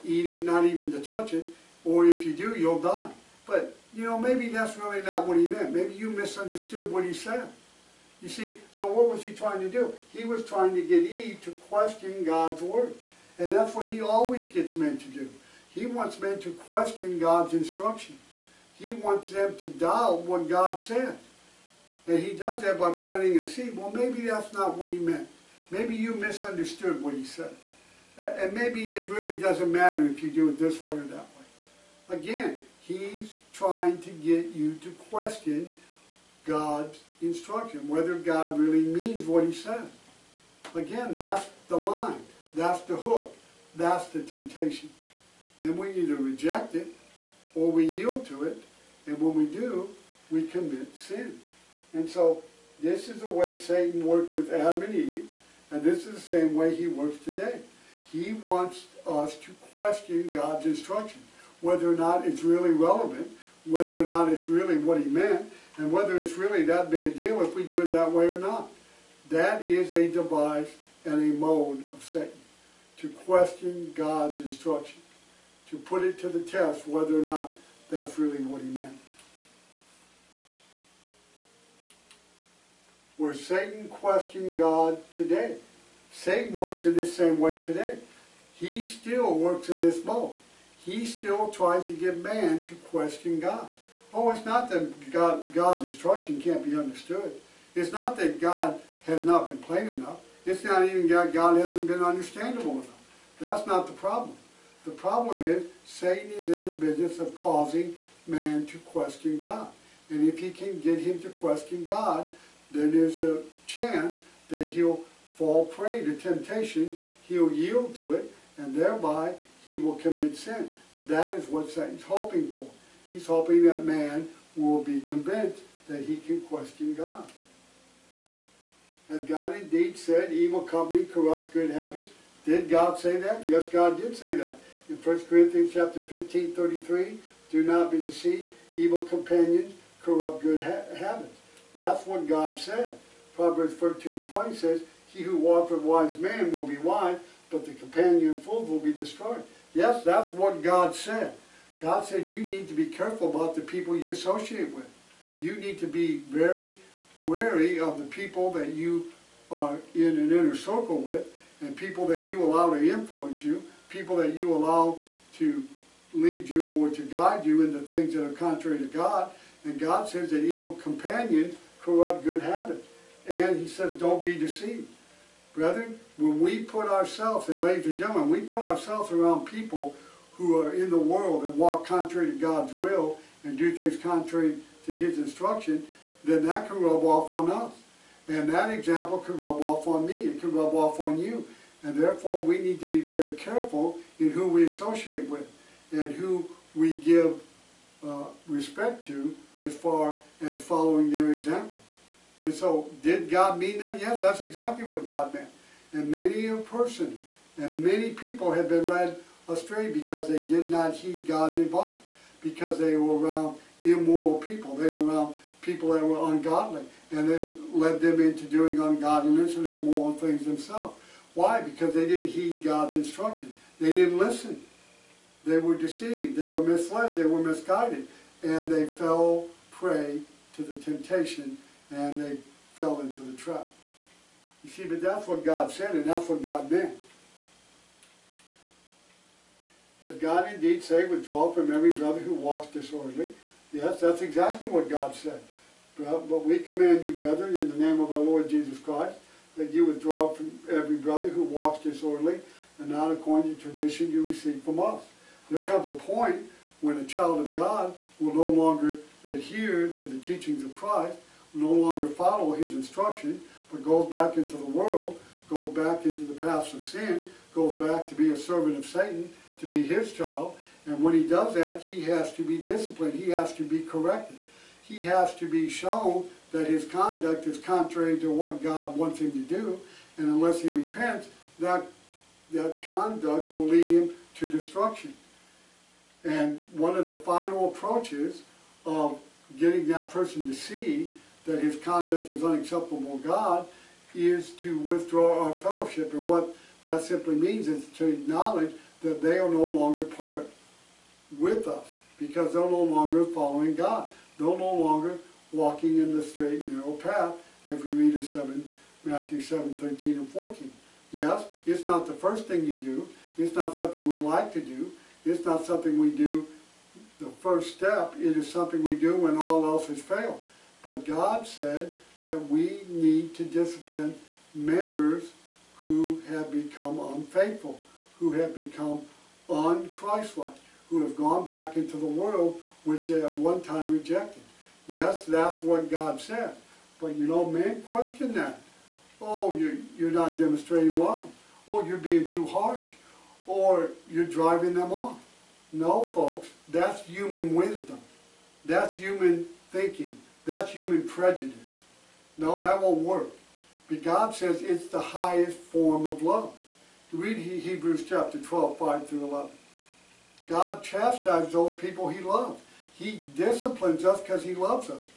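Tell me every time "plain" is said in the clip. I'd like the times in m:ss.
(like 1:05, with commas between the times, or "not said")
1:39.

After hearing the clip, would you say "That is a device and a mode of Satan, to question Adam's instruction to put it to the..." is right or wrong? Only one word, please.
wrong.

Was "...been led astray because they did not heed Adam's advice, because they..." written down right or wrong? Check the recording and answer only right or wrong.
wrong.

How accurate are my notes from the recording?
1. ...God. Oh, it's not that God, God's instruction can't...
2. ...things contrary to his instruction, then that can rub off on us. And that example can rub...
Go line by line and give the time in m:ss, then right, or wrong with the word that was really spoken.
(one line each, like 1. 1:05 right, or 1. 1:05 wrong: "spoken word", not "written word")
1. 1:33 right
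2. 3:03 right.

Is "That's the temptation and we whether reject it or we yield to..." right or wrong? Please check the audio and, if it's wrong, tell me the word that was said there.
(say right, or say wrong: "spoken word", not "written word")
wrong: "either", not "whether".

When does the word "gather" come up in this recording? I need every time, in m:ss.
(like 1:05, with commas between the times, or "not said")
not said.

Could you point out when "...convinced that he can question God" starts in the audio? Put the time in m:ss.
2:05.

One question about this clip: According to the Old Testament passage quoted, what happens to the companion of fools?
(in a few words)
will be destroyed.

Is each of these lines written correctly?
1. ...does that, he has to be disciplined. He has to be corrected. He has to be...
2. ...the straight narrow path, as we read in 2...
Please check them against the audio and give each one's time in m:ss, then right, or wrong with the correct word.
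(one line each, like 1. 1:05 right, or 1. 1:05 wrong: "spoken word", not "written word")
1. 4:31 right
2. 5:06 wrong: "7", not "2".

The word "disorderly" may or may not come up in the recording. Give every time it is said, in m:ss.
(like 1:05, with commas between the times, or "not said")
4:02, 4:11.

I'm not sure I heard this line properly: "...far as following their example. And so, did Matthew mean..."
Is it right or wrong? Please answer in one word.
wrong.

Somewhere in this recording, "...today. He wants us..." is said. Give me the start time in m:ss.
0:57.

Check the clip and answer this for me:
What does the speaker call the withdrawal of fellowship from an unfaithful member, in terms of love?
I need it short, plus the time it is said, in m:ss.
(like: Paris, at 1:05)
highest form of love, at 5:55.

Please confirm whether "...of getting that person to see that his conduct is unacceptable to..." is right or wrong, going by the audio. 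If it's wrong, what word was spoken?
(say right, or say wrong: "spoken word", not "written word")
right.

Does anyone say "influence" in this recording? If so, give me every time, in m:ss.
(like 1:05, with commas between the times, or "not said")
2:42.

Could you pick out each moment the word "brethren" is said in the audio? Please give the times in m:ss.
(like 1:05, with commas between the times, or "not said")
2:55, 4:07.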